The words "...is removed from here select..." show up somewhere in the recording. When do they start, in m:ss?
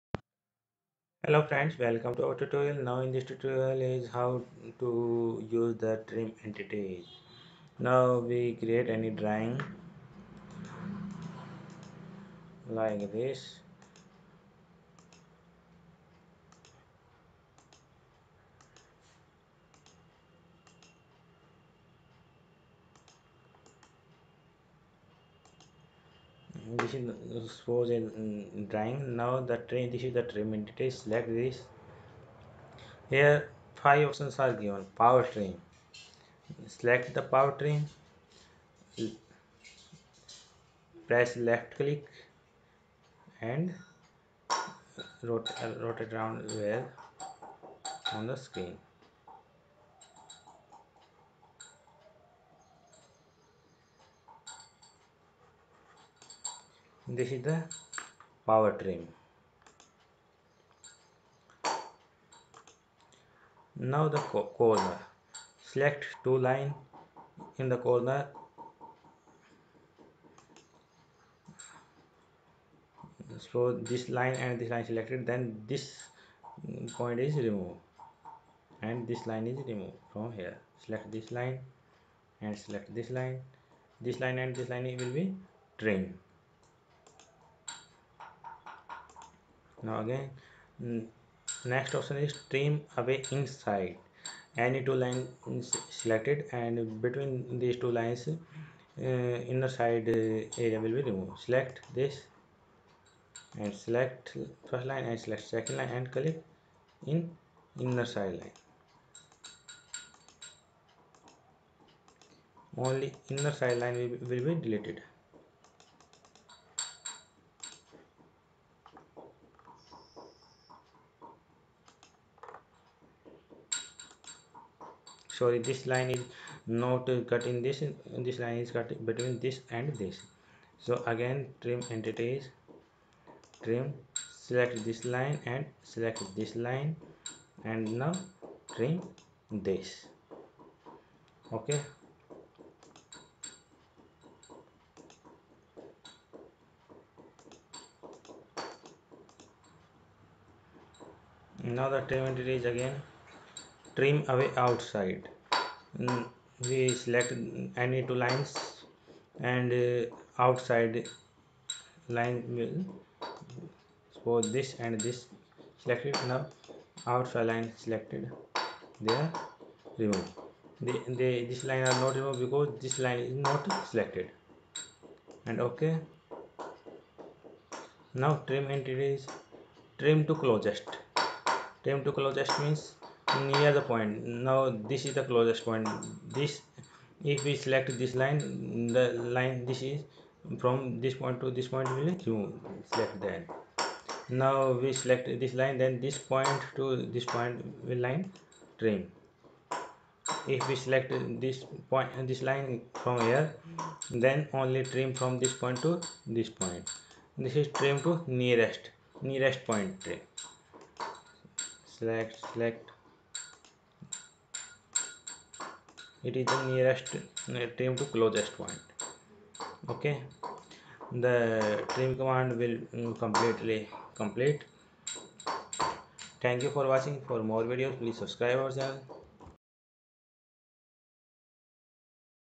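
1:19.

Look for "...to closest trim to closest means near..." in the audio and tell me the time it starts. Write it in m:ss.
3:00.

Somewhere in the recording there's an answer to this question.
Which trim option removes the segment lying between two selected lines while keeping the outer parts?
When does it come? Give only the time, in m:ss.
1:32.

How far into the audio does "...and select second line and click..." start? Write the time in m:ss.
1:45.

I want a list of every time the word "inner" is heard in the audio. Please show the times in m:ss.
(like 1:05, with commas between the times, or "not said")
1:39, 1:47, 1:53.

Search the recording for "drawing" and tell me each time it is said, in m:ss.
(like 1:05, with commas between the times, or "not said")
0:09, 0:28.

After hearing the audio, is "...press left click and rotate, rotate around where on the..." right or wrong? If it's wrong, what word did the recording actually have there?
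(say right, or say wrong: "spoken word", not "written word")
right.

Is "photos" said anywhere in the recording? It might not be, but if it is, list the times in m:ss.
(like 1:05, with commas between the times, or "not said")
not said.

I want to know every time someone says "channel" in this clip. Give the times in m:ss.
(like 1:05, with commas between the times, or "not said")
3:48.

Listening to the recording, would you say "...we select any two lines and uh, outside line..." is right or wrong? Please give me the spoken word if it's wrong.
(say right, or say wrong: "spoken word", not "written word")
right.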